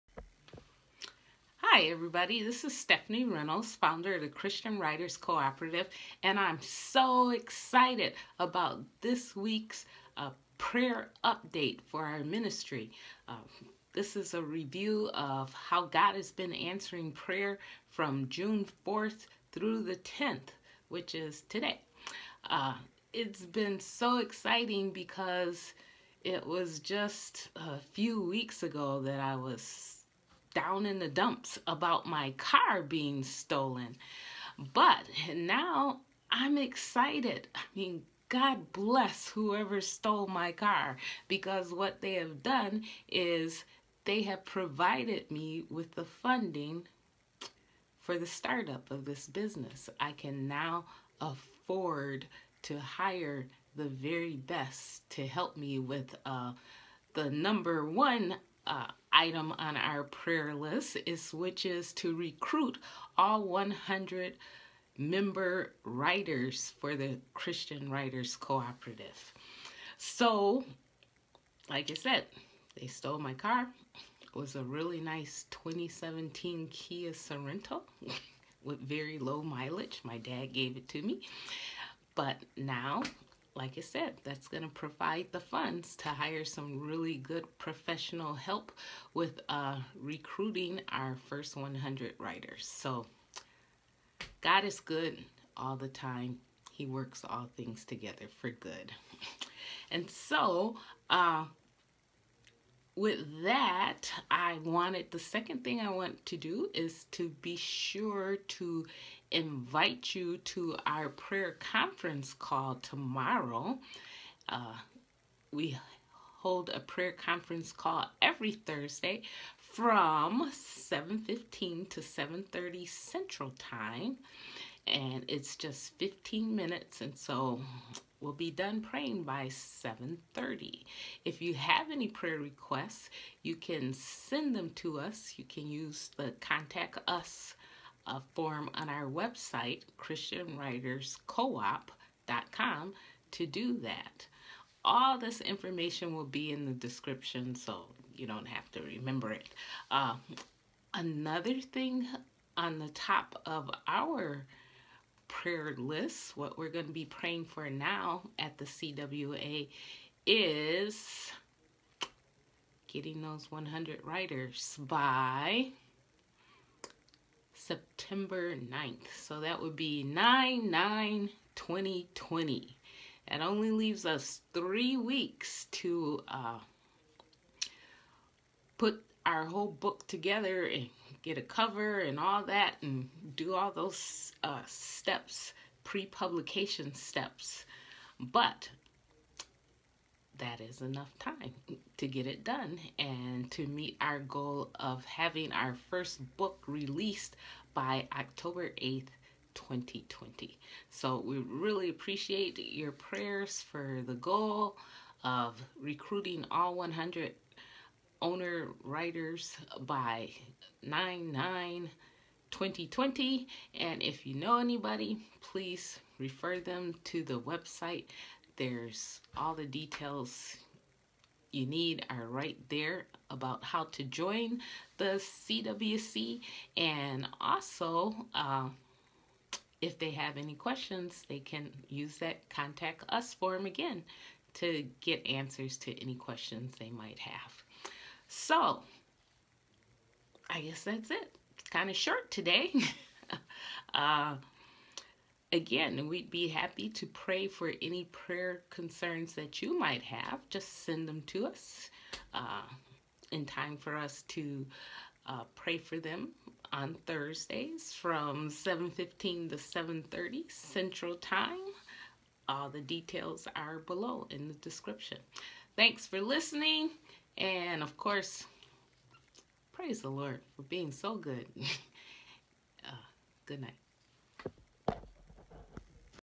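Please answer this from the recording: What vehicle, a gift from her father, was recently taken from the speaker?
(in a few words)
2017 Kia Sorento.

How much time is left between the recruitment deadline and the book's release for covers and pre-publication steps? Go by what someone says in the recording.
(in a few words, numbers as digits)
3 weeks.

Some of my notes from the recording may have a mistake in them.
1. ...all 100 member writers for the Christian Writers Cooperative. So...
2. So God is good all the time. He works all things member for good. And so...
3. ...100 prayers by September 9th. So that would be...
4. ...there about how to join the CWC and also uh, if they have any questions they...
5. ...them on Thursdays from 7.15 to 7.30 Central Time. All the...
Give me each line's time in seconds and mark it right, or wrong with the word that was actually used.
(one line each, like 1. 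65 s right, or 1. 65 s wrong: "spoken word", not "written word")
1. 63 s right
2. 92 s wrong: "together", not "member"
3. 163 s wrong: "writers", not "prayers"
4. 222 s right
5. 255 s right.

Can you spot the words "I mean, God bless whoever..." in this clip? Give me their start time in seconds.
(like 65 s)
37 s.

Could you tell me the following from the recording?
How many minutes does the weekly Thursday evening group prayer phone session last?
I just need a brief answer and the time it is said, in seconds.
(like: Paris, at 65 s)
15 minutes, at 125 s.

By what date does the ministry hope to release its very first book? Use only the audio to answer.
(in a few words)
October 8th, 2020.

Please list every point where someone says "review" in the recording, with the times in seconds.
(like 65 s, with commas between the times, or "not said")
14 s.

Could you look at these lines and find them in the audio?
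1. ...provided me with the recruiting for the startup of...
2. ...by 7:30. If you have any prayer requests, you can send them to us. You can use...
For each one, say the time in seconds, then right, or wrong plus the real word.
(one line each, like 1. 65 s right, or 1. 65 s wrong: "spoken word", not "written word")
1. 44 s wrong: "funding", not "recruiting"
2. 129 s right.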